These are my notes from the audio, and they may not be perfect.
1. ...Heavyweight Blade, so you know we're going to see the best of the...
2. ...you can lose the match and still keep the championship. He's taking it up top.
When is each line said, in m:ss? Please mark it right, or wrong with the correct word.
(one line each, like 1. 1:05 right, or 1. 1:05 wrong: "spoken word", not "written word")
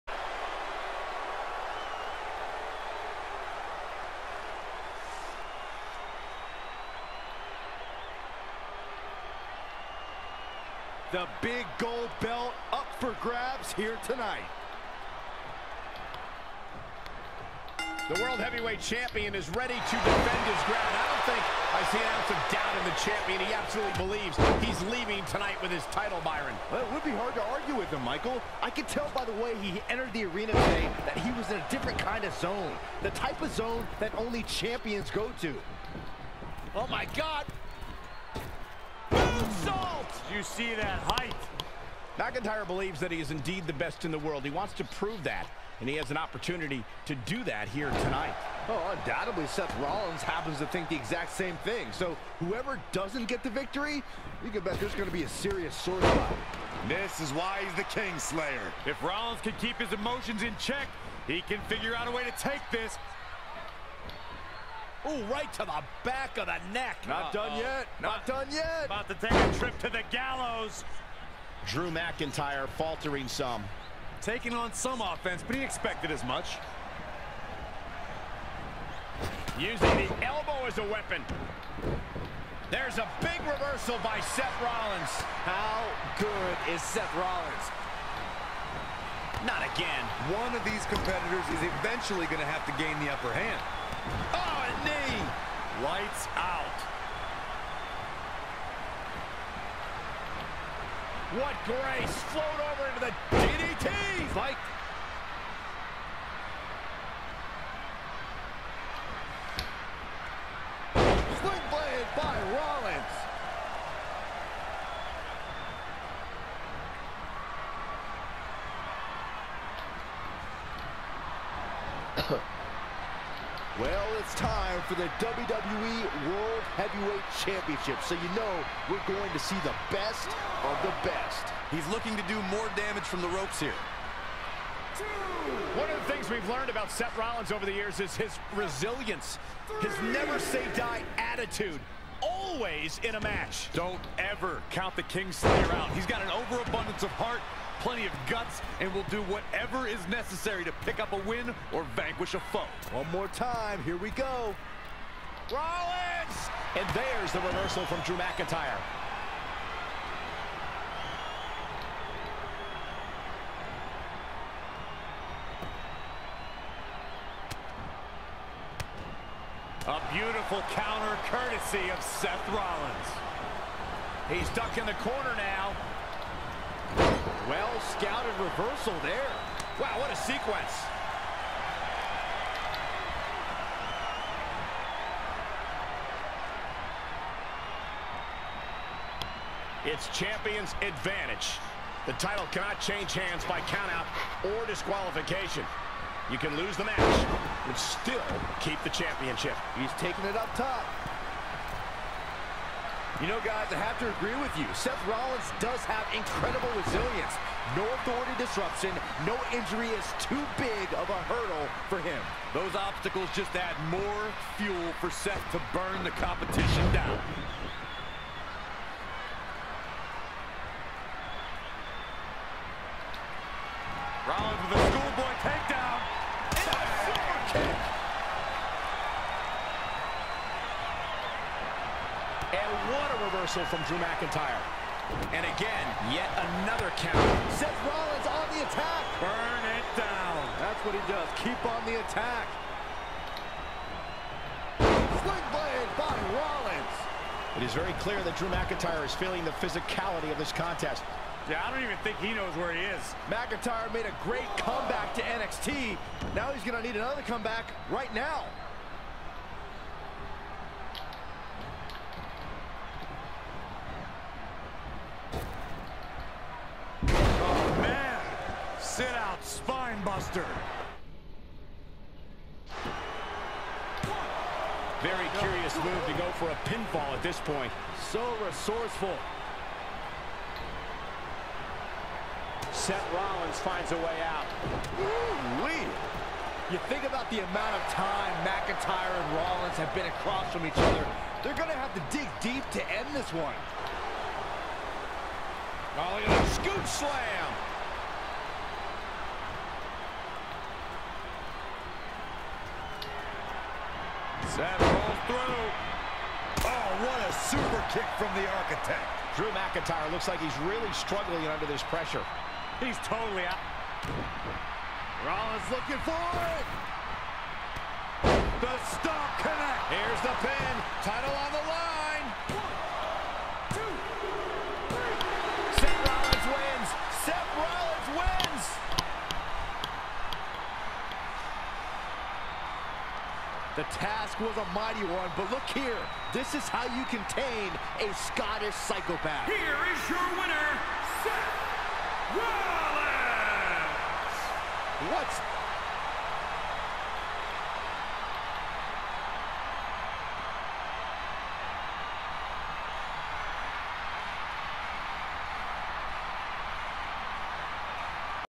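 1. 2:06 wrong: "Championship", not "Blade"
2. 3:16 right.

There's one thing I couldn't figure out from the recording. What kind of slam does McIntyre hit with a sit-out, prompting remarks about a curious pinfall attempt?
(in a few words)
Spine buster.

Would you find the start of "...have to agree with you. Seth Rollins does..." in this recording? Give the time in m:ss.
3:23.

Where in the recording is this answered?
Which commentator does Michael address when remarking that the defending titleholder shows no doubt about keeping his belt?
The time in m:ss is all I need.
0:26.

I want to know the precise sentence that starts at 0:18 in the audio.
The World Heavyweight Champion is ready to defend his ground.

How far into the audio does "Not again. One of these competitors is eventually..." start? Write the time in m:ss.
1:29.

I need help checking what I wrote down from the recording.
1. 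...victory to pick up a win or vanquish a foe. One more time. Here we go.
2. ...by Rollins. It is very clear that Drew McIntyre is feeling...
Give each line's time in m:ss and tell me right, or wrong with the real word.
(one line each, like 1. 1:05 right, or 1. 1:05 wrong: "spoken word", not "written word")
1. 2:30 wrong: "necessary", not "victory"
2. 4:05 right.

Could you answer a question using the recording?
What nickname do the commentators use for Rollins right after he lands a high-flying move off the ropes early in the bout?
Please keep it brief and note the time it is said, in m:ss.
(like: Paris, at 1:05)
King Slayer, at 0:57.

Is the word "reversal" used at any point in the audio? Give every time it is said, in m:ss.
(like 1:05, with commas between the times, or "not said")
1:23, 2:37, 2:58, 3:53.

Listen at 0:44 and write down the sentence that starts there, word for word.
He wants to prove that, and he has an opportunity to do that here tonight.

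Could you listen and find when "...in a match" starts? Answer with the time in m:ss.
2:23.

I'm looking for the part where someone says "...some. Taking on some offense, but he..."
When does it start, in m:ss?
1:13.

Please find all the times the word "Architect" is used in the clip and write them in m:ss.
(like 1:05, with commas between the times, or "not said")
5:08.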